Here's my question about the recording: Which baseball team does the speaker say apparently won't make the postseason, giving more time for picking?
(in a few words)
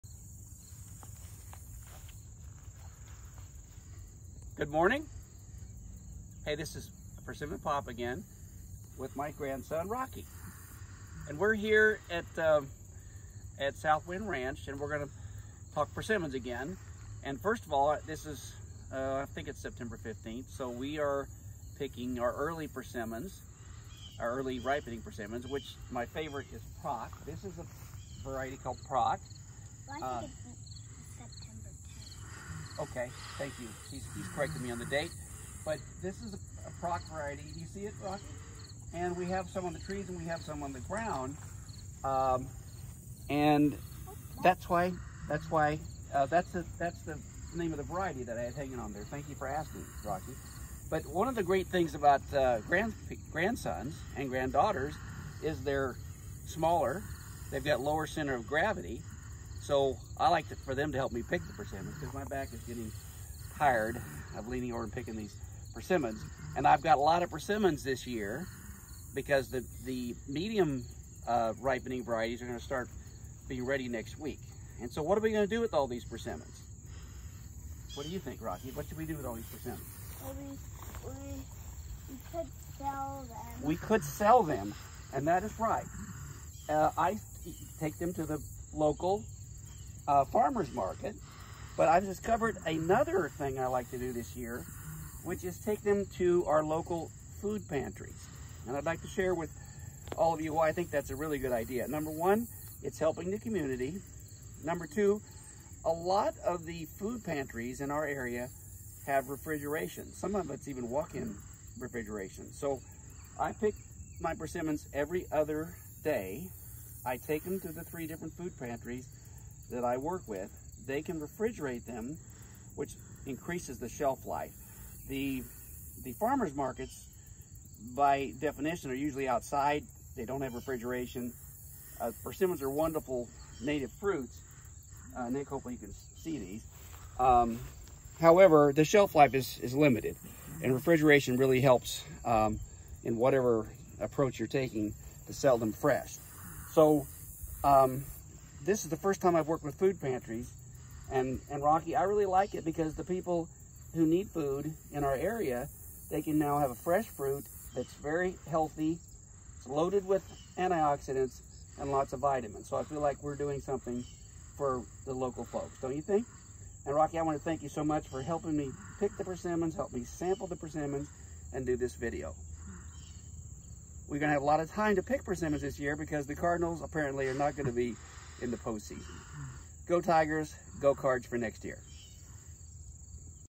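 Cardinals.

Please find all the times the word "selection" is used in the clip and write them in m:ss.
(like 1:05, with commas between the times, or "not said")
not said.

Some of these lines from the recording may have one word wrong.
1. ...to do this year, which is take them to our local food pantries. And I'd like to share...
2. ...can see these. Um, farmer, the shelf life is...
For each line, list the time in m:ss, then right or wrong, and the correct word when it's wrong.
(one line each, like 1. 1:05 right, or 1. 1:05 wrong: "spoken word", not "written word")
1. 1:33 right
2. 2:15 wrong: "however", not "farmer".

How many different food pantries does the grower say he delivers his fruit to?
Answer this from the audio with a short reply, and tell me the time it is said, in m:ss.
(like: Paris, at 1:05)
3, at 1:57.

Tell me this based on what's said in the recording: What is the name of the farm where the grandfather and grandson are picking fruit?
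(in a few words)
Southwind Ranch.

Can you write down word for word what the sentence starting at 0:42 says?
Um, and that's why, that's why, uh, that's, the, that's the name of the variety that I had hanging on there.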